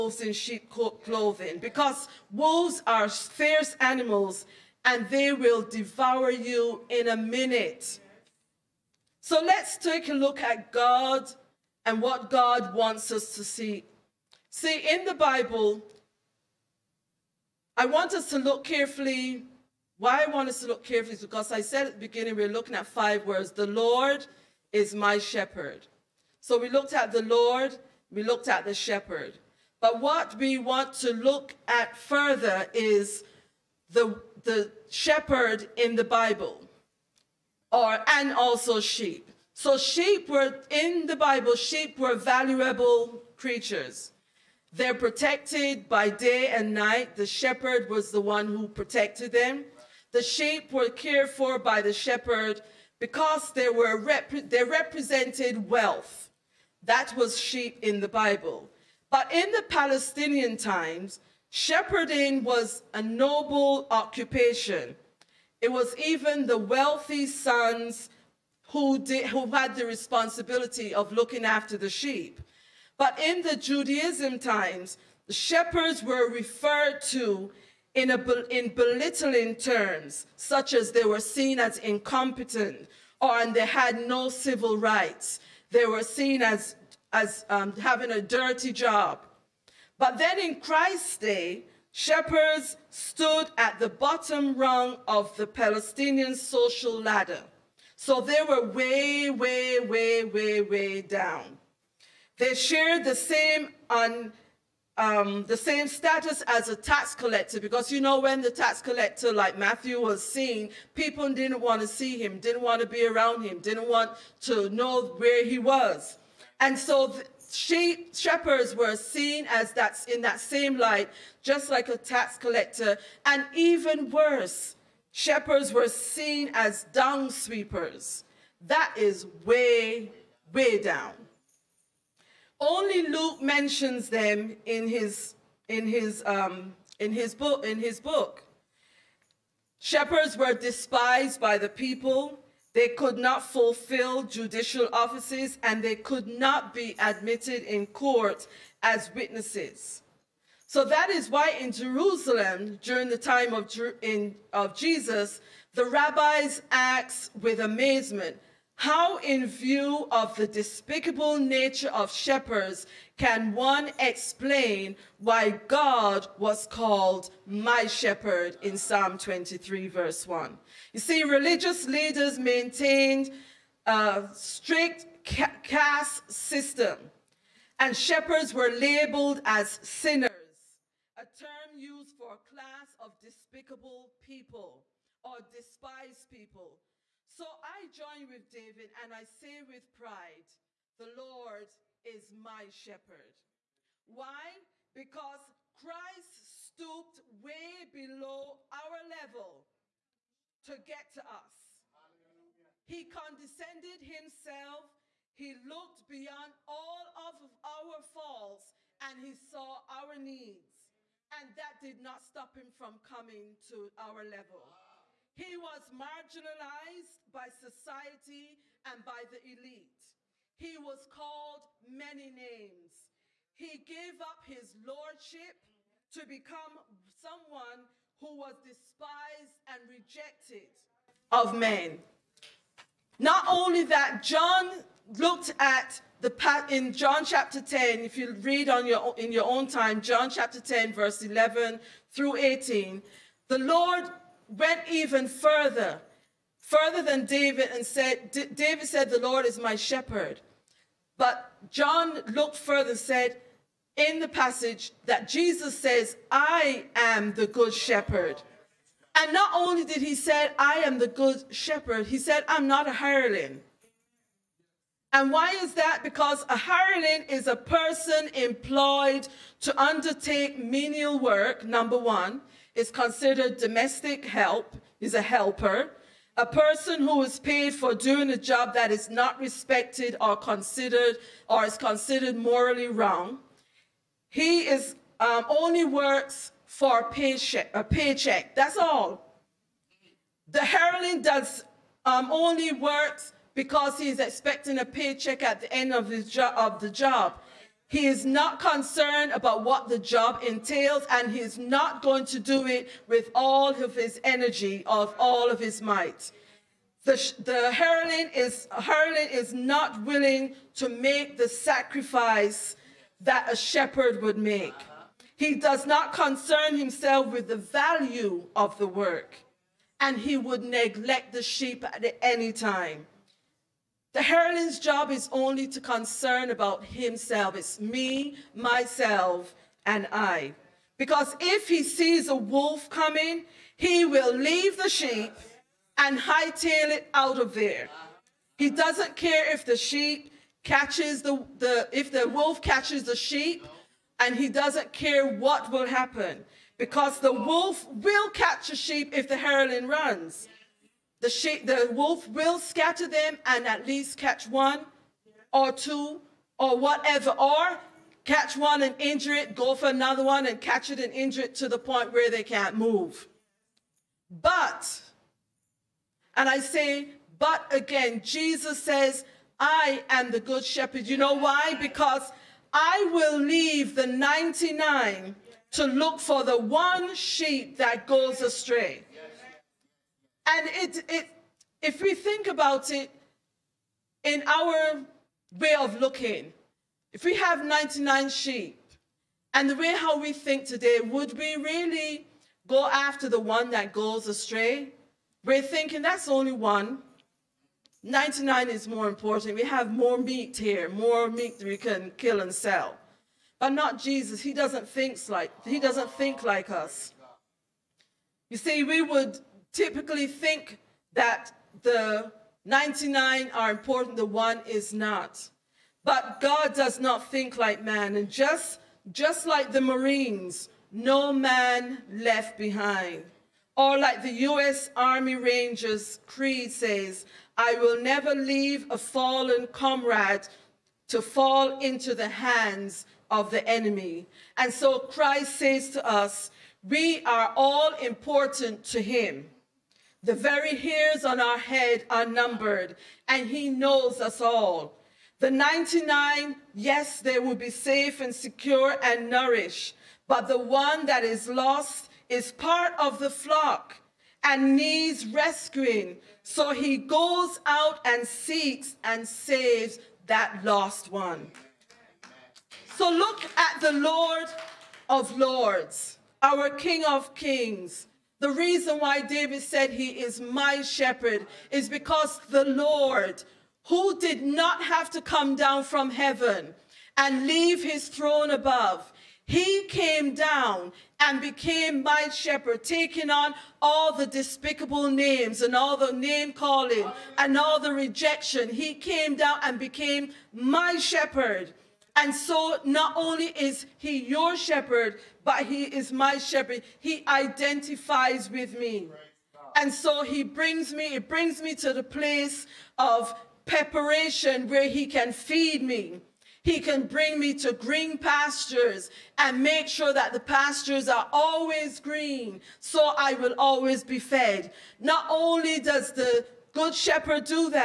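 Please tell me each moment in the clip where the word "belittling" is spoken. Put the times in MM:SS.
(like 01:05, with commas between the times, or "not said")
01:18.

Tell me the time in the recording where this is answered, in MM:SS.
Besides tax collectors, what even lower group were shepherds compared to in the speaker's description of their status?
02:06.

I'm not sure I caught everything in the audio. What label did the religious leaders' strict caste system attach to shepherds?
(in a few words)
Sinners.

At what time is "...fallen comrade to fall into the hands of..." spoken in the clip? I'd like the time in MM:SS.
07:08.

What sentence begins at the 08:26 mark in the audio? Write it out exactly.
He can bring me to green pastures and make sure that the pastures are always green, so I will always be fed.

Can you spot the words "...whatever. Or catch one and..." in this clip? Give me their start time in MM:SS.
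05:56.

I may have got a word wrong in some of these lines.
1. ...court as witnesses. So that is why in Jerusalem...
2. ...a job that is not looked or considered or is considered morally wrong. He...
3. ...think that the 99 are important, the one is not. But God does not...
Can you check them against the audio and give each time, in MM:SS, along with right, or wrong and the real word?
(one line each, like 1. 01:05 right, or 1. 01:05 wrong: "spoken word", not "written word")
1. 02:27 right
2. 04:38 wrong: "respected", not "looked"
3. 06:50 right.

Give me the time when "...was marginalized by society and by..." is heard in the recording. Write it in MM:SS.
03:35.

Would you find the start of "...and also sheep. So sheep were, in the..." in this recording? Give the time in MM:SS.
00:38.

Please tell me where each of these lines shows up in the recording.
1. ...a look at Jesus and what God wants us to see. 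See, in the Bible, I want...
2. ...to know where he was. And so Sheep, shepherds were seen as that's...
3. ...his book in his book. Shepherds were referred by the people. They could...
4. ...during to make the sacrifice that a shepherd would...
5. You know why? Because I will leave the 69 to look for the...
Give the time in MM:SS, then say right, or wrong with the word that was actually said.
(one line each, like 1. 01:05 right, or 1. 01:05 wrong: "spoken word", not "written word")
1. 00:10 wrong: "God", not "Jesus"
2. 01:54 right
3. 02:17 wrong: "despised", not "referred"
4. 05:10 wrong: "willing", not "during"
5. 06:11 wrong: "99", not "69".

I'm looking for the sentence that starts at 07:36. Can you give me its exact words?
So he goes out and seeks and saves that lost one.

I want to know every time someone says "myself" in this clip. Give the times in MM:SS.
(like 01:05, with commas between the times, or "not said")
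05:28.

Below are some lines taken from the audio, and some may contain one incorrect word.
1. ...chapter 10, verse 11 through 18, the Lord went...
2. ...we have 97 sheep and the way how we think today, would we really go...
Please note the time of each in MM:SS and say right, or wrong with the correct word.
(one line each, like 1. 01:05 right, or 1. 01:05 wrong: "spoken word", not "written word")
1. 04:00 right
2. 06:27 wrong: "99", not "97".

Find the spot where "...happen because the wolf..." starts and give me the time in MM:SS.
05:45.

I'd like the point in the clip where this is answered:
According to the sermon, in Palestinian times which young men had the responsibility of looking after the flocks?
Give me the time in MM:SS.
01:06.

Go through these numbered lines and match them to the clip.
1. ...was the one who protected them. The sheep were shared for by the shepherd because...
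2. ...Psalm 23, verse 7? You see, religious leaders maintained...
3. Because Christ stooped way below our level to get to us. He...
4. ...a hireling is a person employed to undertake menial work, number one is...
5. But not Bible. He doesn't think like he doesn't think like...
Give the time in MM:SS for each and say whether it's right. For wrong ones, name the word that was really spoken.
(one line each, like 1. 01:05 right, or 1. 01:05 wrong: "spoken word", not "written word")
1. 00:47 wrong: "cared", not "shared"
2. 02:48 wrong: "1", not "7"
3. 03:14 right
4. 04:26 right
5. 06:43 wrong: "Jesus", not "Bible".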